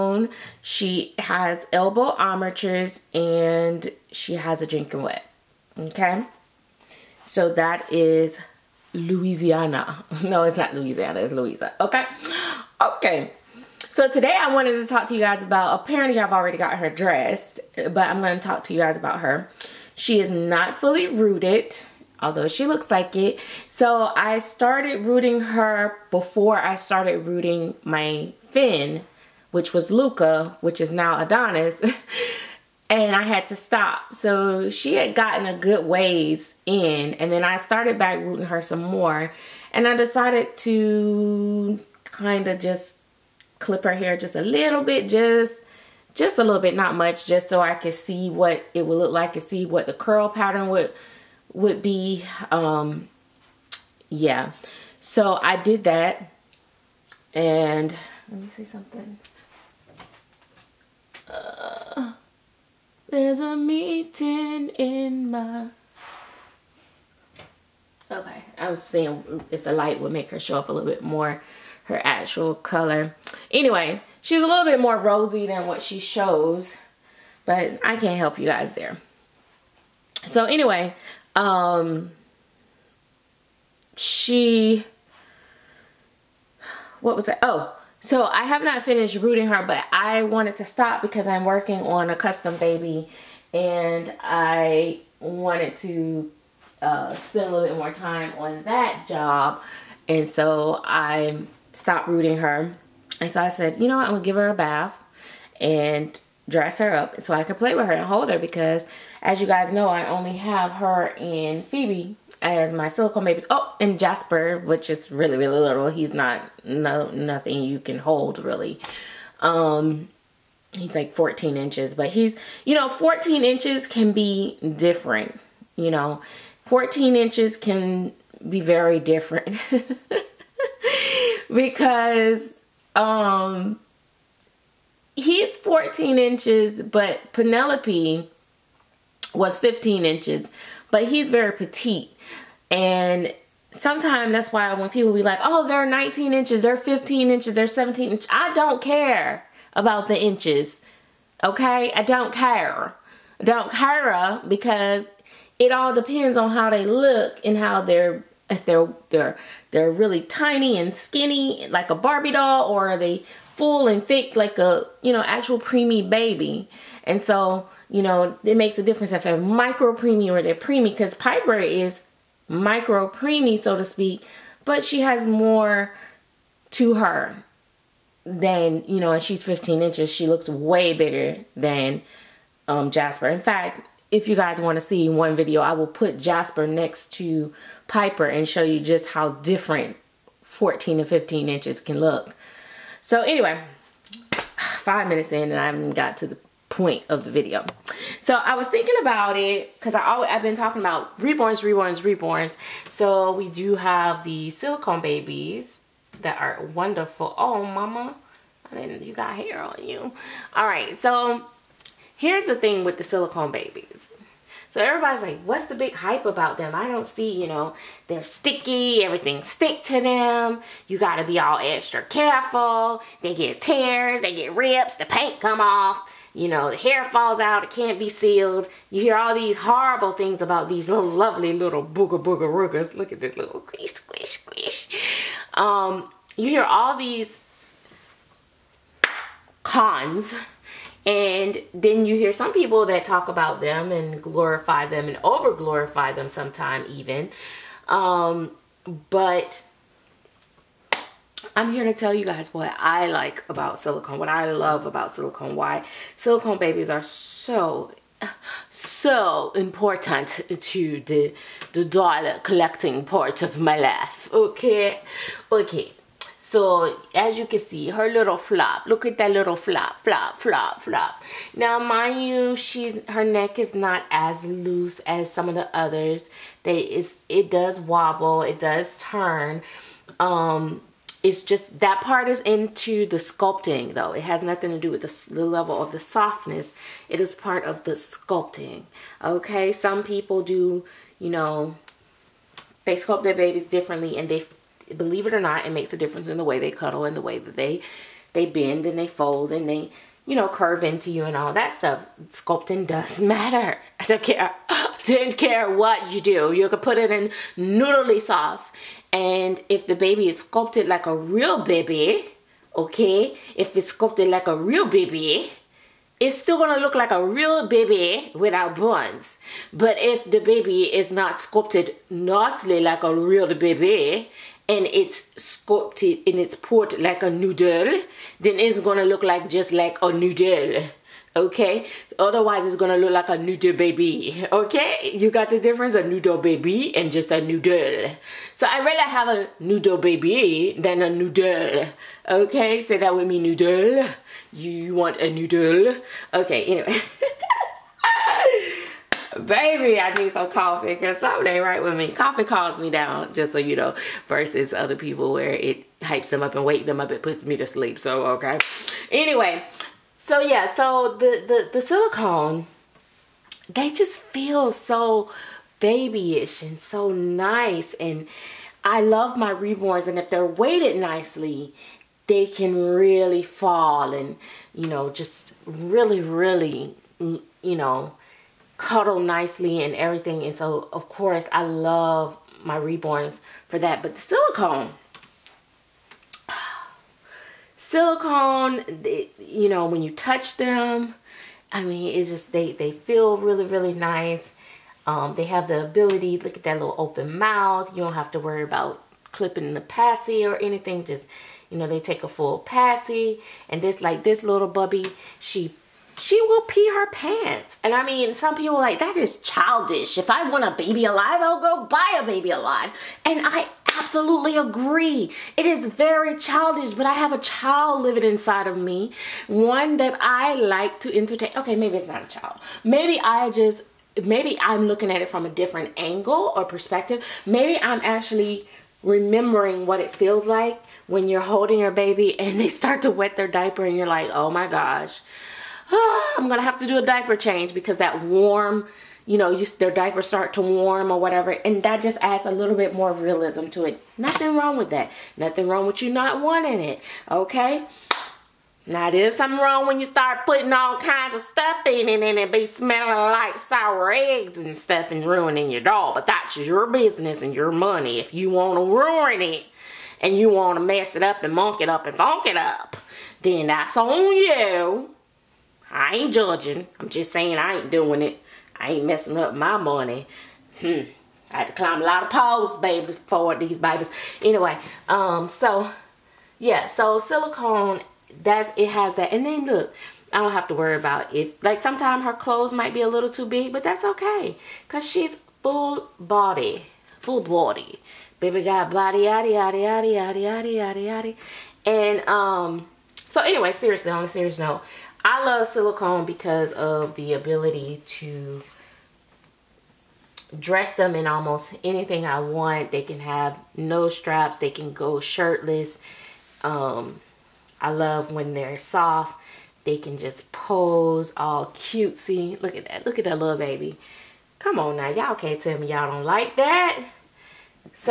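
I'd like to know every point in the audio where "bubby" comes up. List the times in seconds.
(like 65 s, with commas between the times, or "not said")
404 s.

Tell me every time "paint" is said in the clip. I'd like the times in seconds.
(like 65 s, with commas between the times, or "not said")
225 s.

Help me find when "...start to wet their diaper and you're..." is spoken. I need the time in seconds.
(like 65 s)
432 s.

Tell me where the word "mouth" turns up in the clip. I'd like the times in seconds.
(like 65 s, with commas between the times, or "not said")
397 s.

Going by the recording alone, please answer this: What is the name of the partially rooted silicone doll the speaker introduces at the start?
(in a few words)
Louisa.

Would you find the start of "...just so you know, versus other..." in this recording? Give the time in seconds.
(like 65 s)
353 s.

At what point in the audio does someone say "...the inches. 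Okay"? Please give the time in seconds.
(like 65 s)
150 s.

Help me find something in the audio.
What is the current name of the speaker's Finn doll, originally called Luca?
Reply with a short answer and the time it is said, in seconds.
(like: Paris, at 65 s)
Adonis, at 31 s.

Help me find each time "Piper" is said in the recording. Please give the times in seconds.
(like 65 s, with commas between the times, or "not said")
171 s, 187 s.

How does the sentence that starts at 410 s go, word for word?
If I want a baby alive, I'll go buy a baby alive.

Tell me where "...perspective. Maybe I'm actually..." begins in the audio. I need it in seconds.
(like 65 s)
426 s.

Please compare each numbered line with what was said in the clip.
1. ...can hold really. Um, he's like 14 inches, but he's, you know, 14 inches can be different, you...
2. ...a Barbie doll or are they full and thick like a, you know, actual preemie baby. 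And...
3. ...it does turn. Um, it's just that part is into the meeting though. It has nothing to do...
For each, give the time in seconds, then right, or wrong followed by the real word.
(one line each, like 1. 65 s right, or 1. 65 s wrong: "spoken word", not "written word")
1. 117 s right
2. 161 s right
3. 278 s wrong: "sculpting", not "meeting".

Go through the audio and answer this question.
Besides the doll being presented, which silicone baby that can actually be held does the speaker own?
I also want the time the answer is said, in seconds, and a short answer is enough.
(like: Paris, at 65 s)
Phoebe, at 111 s.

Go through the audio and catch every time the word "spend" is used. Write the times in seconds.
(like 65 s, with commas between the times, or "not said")
97 s.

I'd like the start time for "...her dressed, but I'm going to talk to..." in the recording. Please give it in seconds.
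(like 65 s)
16 s.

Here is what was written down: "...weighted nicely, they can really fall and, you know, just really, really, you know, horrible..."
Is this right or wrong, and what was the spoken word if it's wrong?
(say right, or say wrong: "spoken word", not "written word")
wrong: "cuddle", not "horrible".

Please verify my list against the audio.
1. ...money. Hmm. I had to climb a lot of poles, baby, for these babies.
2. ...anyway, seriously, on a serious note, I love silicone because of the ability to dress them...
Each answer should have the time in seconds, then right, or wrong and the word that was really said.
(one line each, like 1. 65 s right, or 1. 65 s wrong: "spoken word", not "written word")
1. 469 s right
2. 493 s right.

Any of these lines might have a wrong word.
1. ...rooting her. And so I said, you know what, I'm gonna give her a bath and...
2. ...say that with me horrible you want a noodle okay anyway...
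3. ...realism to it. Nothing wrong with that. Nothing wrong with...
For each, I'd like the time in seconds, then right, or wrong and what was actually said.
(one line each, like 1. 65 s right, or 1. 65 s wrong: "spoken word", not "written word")
1. 102 s right
2. 342 s wrong: "noodle", not "horrible"
3. 443 s right.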